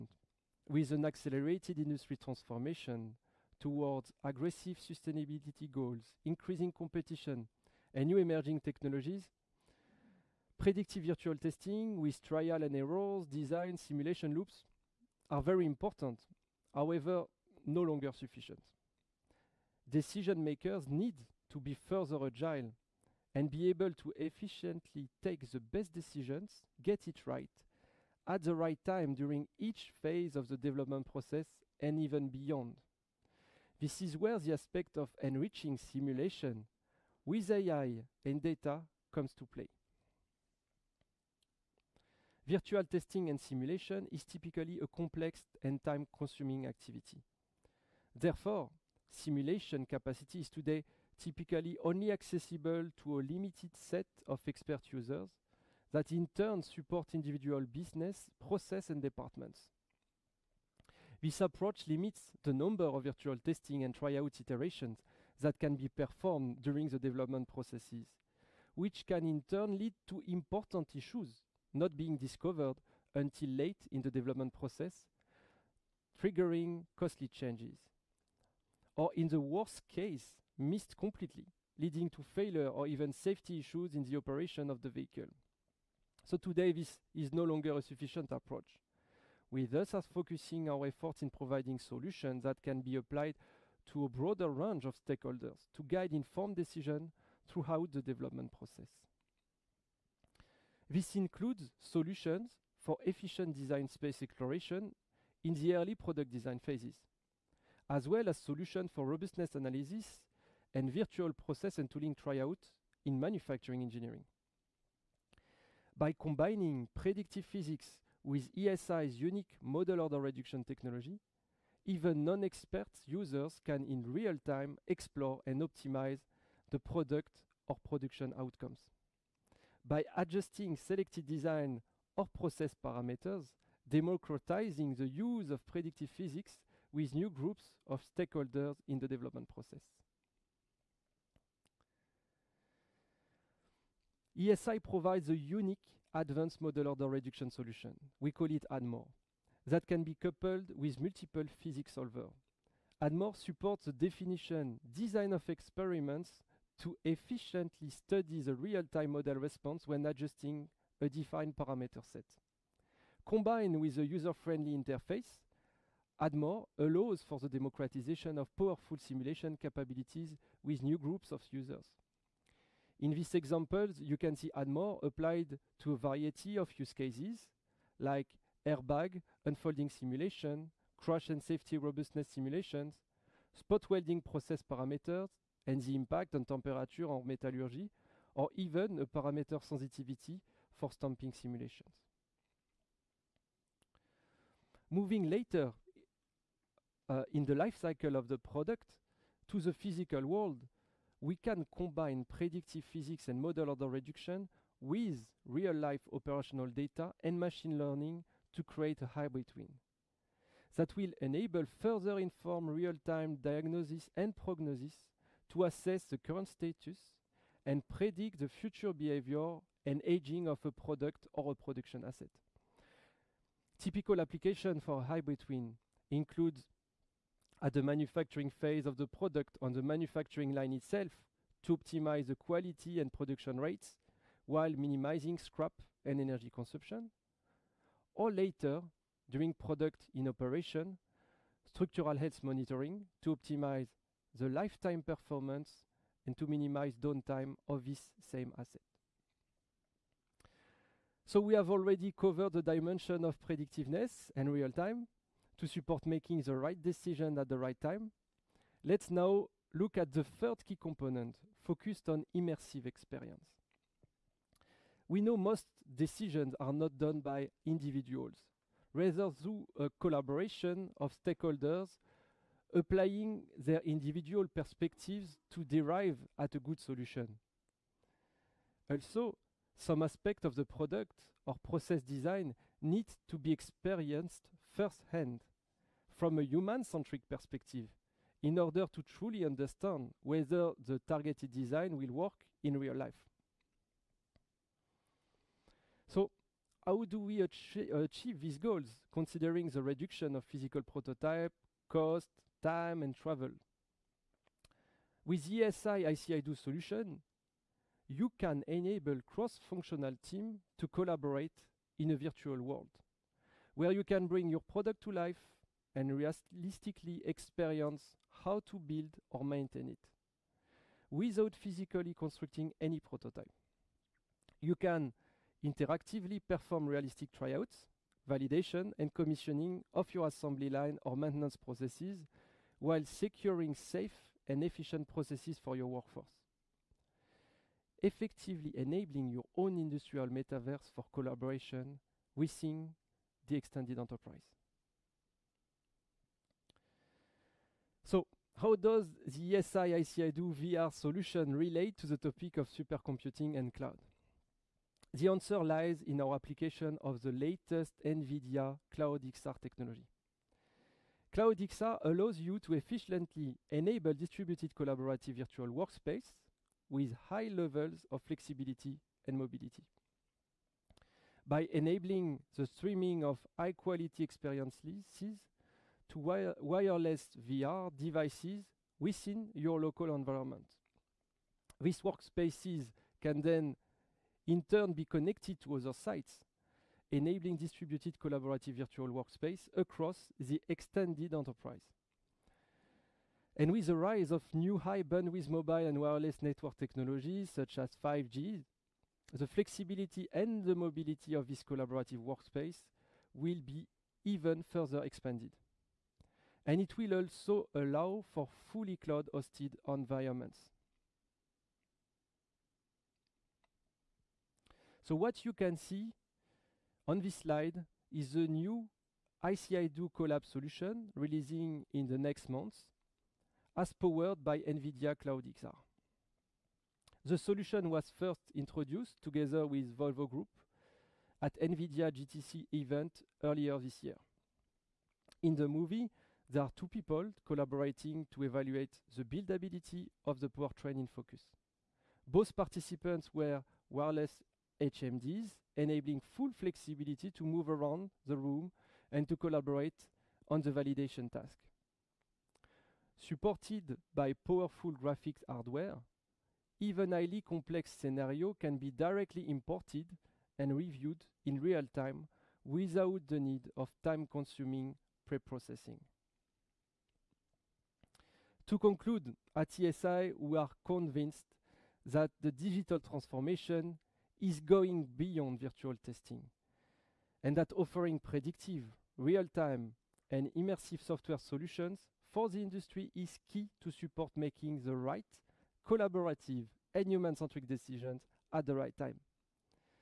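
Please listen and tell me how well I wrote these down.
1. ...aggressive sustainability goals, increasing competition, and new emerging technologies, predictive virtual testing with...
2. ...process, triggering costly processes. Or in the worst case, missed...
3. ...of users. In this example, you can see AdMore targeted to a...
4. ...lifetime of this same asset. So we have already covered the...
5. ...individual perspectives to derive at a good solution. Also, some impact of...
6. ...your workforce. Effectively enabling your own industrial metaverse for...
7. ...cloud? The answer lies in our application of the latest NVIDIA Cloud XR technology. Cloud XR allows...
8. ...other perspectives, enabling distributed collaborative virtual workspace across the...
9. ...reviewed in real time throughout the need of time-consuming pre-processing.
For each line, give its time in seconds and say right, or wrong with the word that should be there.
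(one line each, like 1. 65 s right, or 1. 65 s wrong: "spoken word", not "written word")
1. 4 s right
2. 74 s wrong: "changes", not "processes"
3. 171 s wrong: "applied", not "targeted"
4. 247 s wrong: "downtime", not "lifetime"
5. 273 s wrong: "aspect", not "impact"
6. 335 s right
7. 353 s right
8. 385 s wrong: "sites", not "perspectives"
9. 460 s wrong: "without", not "throughout".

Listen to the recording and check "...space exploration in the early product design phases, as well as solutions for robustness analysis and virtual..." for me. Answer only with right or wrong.
right.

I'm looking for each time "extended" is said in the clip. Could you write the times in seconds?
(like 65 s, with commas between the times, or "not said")
343 s, 390 s.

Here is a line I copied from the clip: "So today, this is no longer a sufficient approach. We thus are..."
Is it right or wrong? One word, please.
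right.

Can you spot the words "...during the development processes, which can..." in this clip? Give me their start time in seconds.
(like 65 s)
66 s.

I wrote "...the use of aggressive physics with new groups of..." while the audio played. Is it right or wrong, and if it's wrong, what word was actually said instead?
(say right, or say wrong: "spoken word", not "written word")
wrong: "predictive", not "aggressive".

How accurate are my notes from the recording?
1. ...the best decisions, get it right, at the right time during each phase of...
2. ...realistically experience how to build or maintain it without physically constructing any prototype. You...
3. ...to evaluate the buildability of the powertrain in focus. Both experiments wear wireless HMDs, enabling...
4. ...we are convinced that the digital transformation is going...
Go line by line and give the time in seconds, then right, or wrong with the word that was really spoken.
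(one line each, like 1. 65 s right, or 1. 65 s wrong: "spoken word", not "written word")
1. 25 s right
2. 316 s right
3. 438 s wrong: "participants", not "experiments"
4. 470 s right.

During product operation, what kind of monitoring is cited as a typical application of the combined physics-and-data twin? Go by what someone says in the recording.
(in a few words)
structural health monitoring.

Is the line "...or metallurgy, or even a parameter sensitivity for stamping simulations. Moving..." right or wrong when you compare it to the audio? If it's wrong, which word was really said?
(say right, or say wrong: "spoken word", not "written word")
right.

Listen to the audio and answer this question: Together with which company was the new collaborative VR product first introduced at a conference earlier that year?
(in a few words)
Volvo Group.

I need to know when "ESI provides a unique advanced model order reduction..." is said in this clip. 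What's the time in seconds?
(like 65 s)
144 s.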